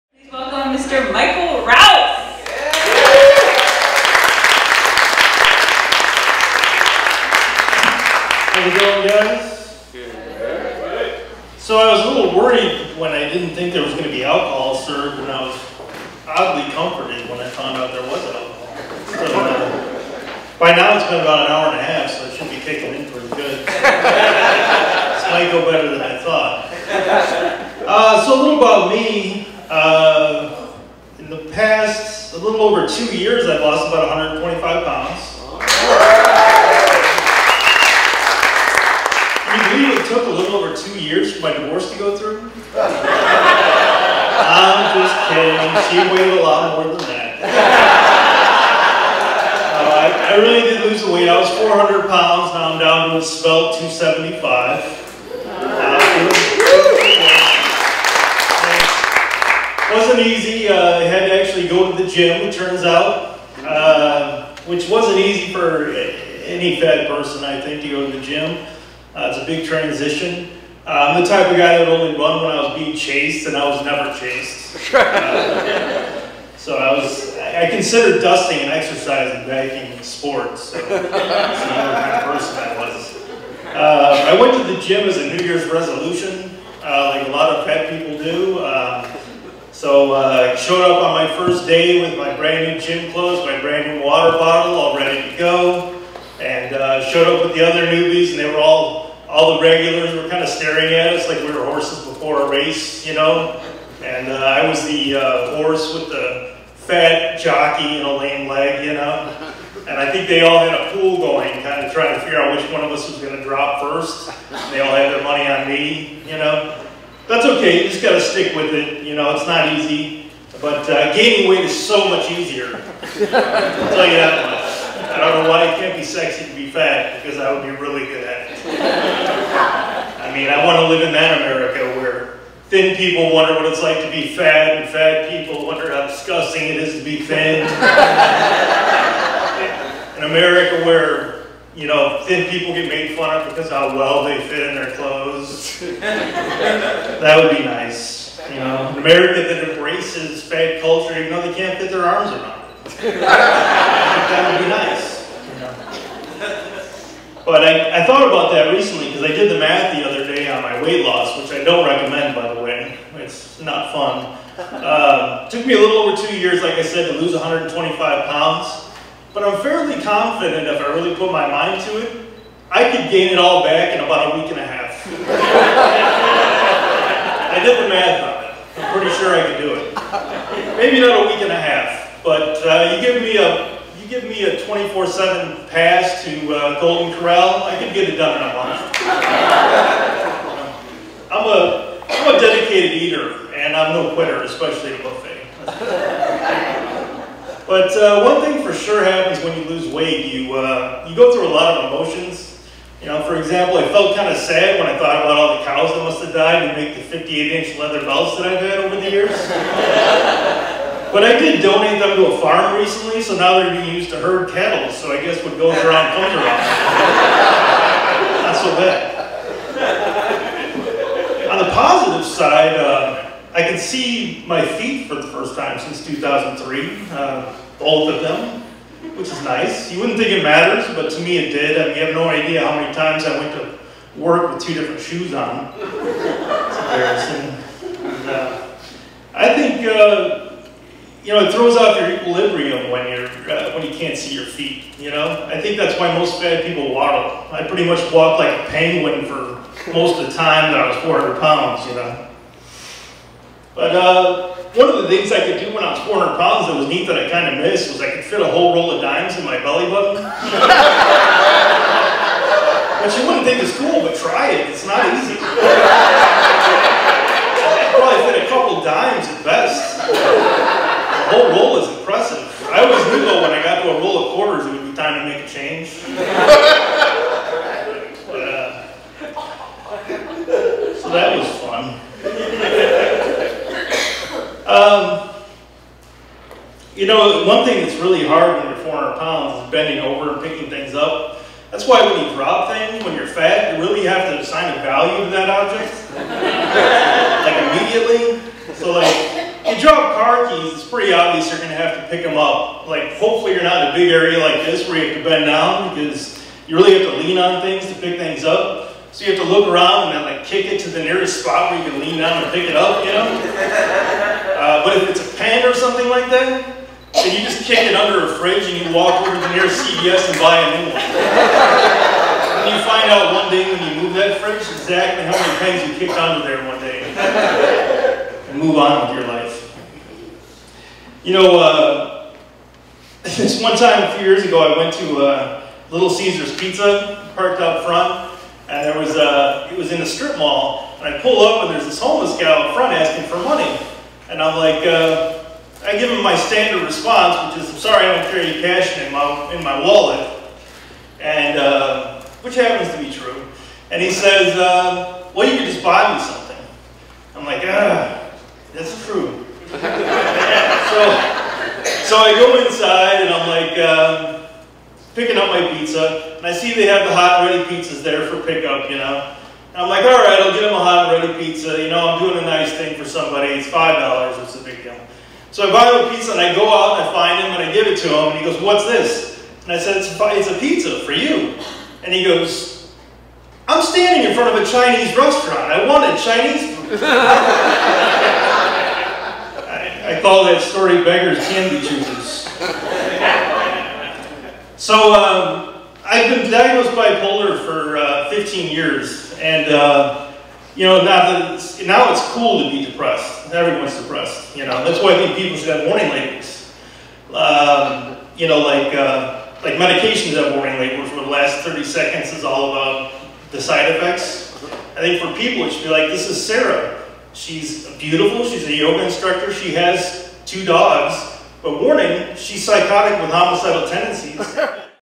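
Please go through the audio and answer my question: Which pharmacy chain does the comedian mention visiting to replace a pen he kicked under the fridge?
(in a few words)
CVS.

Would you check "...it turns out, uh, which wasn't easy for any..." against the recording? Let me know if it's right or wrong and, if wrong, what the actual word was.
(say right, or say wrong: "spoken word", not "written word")
right.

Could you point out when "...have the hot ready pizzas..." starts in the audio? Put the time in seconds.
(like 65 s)
366 s.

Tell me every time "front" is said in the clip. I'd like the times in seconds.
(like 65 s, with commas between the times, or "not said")
337 s, 342 s, 384 s.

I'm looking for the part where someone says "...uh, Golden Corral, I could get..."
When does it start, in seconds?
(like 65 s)
186 s.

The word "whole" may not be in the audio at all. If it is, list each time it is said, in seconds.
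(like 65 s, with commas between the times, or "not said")
258 s, 271 s.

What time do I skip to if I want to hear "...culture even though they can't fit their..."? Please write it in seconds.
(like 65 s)
150 s.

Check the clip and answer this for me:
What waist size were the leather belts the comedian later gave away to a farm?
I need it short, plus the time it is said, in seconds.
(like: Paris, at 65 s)
58-inch, at 207 s.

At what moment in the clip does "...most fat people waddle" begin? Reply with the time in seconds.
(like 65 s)
246 s.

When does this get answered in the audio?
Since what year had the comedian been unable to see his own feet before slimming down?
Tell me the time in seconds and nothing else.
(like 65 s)
226 s.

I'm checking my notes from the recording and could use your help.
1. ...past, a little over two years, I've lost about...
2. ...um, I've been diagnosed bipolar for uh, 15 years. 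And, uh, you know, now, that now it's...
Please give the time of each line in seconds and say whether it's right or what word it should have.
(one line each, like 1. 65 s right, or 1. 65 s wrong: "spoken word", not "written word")
1. 31 s right
2. 395 s right.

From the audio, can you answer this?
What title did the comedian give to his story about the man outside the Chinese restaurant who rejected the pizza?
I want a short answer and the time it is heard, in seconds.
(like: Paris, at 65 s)
Beggar's Candy Choosers, at 391 s.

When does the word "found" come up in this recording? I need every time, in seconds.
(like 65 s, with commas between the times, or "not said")
17 s.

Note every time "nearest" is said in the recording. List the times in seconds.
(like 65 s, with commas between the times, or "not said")
311 s, 319 s.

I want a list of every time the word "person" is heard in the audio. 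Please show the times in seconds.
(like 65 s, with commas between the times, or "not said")
67 s, 82 s.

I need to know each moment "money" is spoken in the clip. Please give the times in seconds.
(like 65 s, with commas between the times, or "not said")
115 s, 343 s.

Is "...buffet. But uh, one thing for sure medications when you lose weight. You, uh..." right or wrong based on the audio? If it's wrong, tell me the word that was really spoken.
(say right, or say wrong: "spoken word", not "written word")
wrong: "happens", not "medications".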